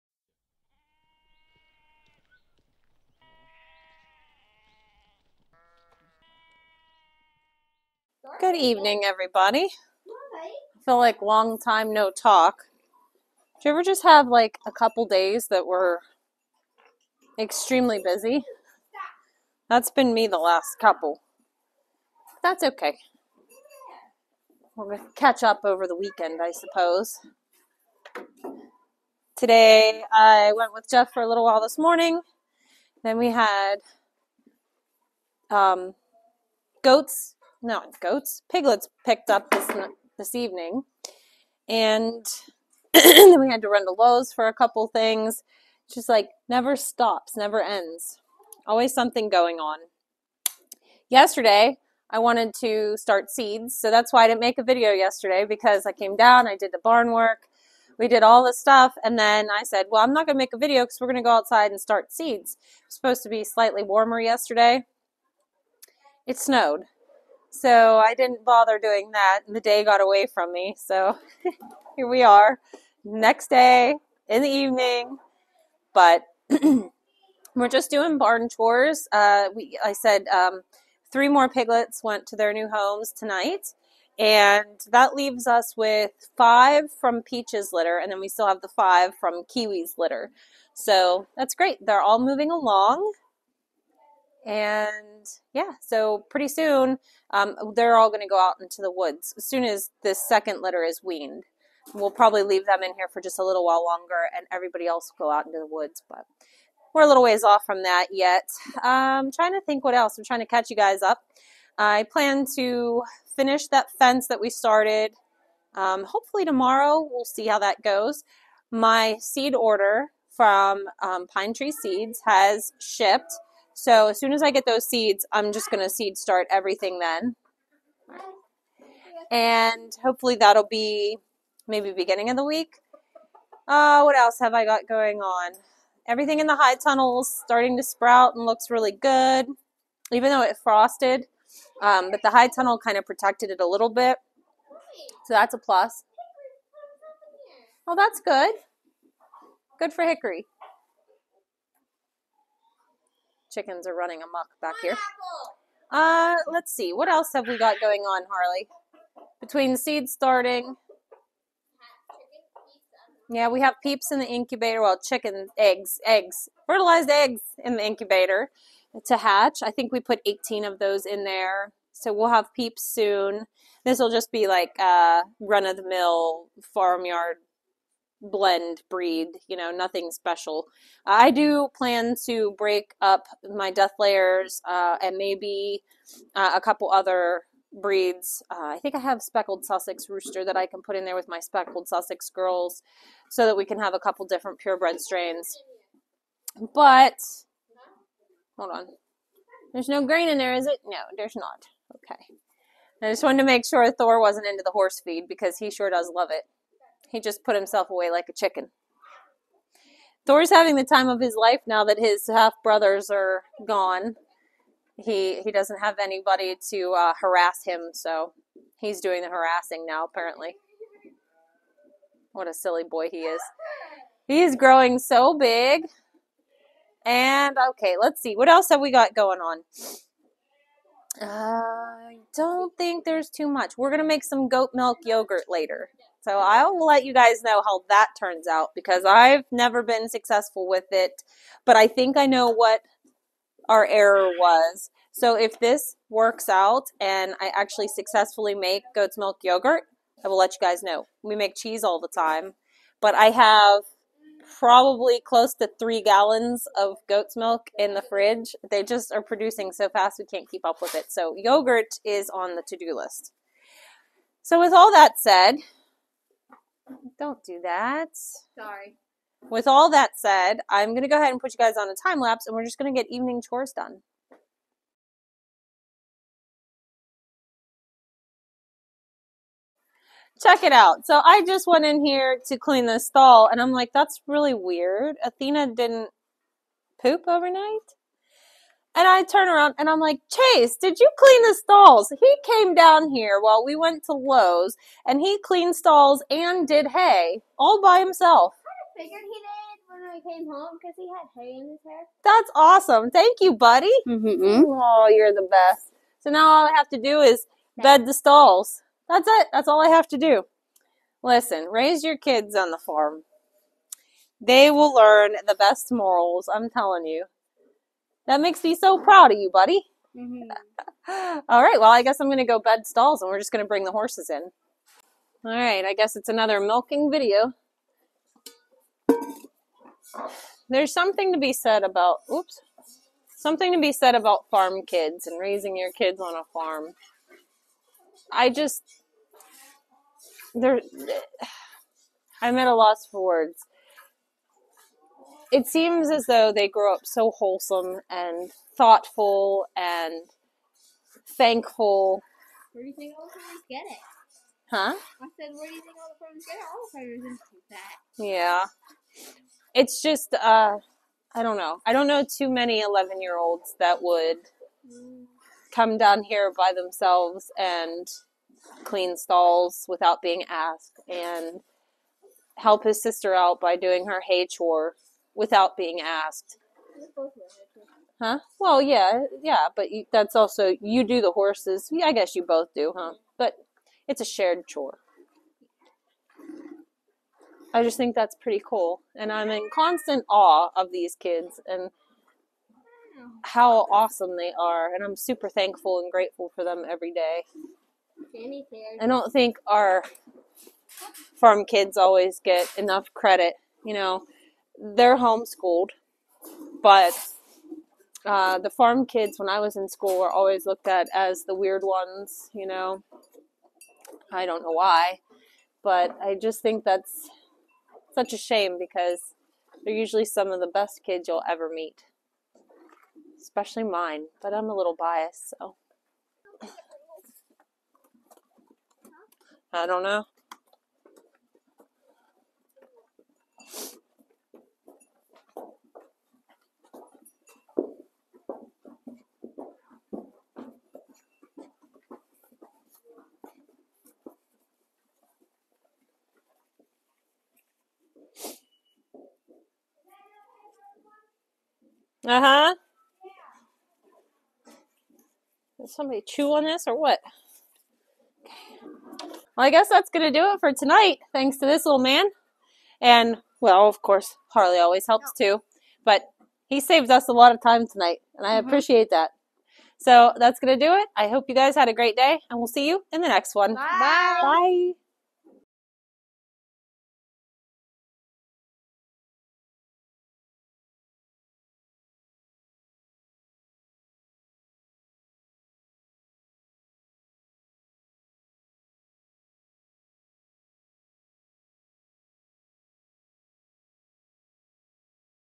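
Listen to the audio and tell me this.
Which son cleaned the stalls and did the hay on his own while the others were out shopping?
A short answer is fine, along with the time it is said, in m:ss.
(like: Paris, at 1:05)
Chase, at 4:50.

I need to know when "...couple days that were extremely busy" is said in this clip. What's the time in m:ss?
0:14.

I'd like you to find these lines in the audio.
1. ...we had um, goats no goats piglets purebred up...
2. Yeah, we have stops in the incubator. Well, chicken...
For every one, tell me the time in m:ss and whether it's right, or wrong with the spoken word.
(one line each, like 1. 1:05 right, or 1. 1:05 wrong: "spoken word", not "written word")
1. 0:33 wrong: "picked", not "purebred"
2. 2:43 wrong: "peeps", not "stops".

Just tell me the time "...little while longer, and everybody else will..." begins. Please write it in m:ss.
1:43.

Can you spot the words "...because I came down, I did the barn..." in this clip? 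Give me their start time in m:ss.
0:55.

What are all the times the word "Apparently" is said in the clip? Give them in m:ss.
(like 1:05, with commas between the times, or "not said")
3:40.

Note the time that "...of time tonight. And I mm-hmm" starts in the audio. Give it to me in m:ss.
7:47.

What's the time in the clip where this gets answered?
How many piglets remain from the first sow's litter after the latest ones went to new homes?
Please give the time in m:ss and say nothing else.
1:26.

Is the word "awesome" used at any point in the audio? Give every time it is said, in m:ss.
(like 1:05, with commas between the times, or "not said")
5:02, 6:33.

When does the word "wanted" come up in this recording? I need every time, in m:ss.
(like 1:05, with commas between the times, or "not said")
0:52, 3:23.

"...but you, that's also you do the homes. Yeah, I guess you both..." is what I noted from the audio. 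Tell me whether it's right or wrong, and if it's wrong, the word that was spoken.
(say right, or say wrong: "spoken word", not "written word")
wrong: "horses", not "homes".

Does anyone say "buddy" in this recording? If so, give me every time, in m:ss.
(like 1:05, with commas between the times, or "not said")
5:03, 5:19.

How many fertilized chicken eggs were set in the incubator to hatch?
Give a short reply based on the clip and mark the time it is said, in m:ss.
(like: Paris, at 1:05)
18, at 2:50.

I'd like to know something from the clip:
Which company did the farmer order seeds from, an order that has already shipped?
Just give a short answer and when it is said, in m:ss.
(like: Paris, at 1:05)
Pine Tree Seeds, at 2:01.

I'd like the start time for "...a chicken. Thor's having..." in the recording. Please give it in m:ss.
3:28.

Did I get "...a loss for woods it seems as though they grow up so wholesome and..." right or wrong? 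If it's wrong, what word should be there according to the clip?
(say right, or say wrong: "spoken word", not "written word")
wrong: "words", not "woods".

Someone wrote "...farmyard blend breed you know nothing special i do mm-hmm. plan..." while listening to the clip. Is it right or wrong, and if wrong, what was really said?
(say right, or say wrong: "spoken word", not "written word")
right.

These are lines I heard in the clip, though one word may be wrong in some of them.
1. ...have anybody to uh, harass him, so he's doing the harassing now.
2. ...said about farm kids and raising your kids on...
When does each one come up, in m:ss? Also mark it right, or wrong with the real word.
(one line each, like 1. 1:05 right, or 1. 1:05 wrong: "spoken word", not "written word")
1. 3:35 right
2. 5:33 right.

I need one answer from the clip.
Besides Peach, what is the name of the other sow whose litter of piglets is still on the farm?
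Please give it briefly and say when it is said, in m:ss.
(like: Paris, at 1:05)
Kiwi, at 1:29.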